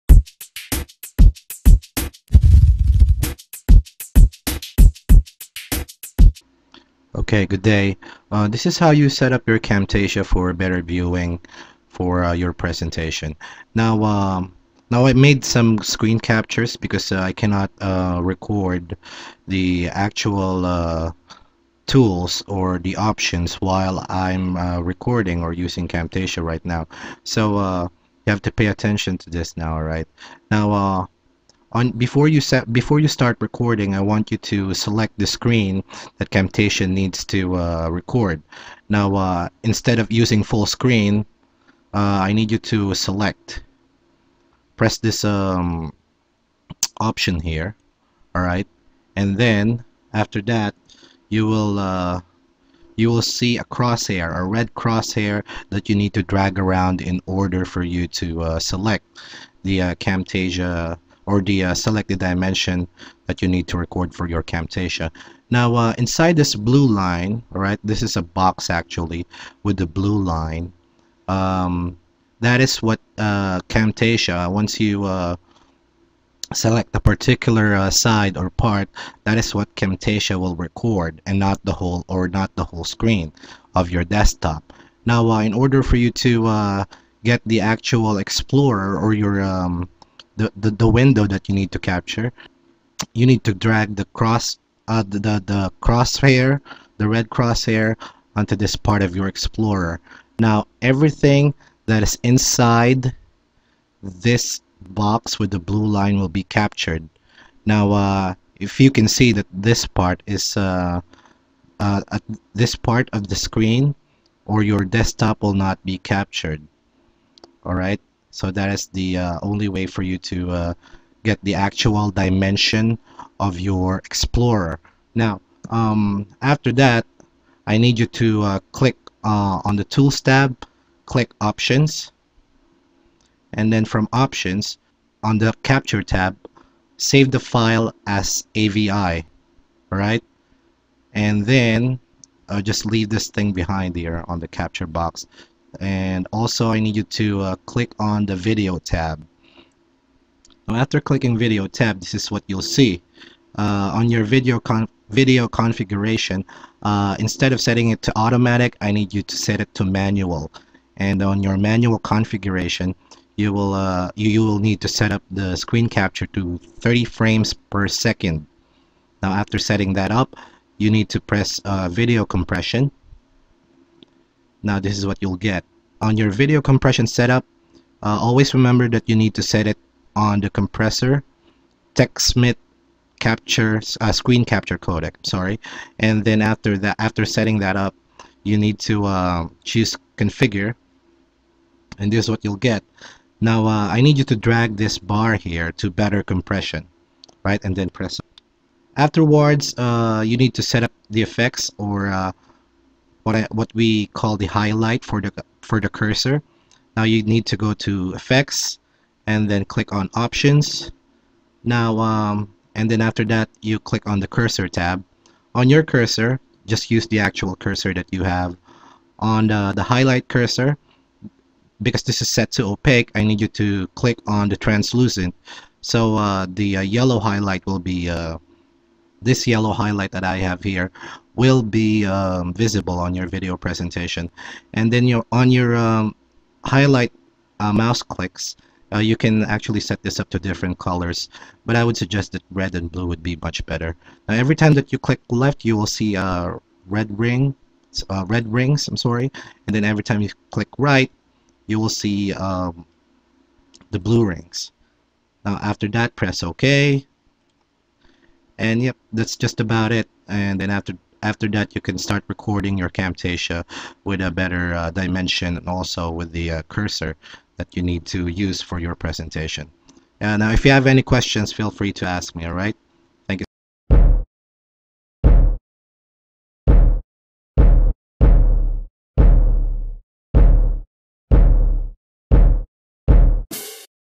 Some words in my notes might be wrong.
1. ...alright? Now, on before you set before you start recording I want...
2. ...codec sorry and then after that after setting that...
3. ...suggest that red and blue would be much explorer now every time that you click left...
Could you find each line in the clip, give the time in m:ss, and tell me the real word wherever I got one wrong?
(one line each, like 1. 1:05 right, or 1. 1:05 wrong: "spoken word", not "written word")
1. 0:29 right
2. 3:04 right
3. 4:01 wrong: "better", not "explorer".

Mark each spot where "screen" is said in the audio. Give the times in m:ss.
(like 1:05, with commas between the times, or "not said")
0:15, 0:35, 0:40, 1:22, 1:53, 2:45, 3:04.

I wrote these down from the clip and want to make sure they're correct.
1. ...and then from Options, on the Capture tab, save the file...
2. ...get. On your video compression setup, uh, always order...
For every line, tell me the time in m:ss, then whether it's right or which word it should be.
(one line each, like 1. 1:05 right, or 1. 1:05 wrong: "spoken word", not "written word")
1. 2:13 right
2. 2:55 wrong: "remember", not "order".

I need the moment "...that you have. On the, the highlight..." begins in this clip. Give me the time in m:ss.
3:37.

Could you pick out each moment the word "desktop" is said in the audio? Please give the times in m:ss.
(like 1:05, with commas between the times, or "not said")
1:24, 1:54.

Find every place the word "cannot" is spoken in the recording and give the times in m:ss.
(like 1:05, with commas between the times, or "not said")
0:17.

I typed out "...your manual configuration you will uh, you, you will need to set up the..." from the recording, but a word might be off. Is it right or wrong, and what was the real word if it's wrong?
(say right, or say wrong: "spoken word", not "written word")
right.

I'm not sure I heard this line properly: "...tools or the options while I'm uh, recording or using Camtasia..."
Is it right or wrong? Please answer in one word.
right.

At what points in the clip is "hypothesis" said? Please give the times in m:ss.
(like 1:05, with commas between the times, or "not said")
not said.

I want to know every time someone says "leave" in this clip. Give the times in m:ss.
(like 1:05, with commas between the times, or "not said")
2:22.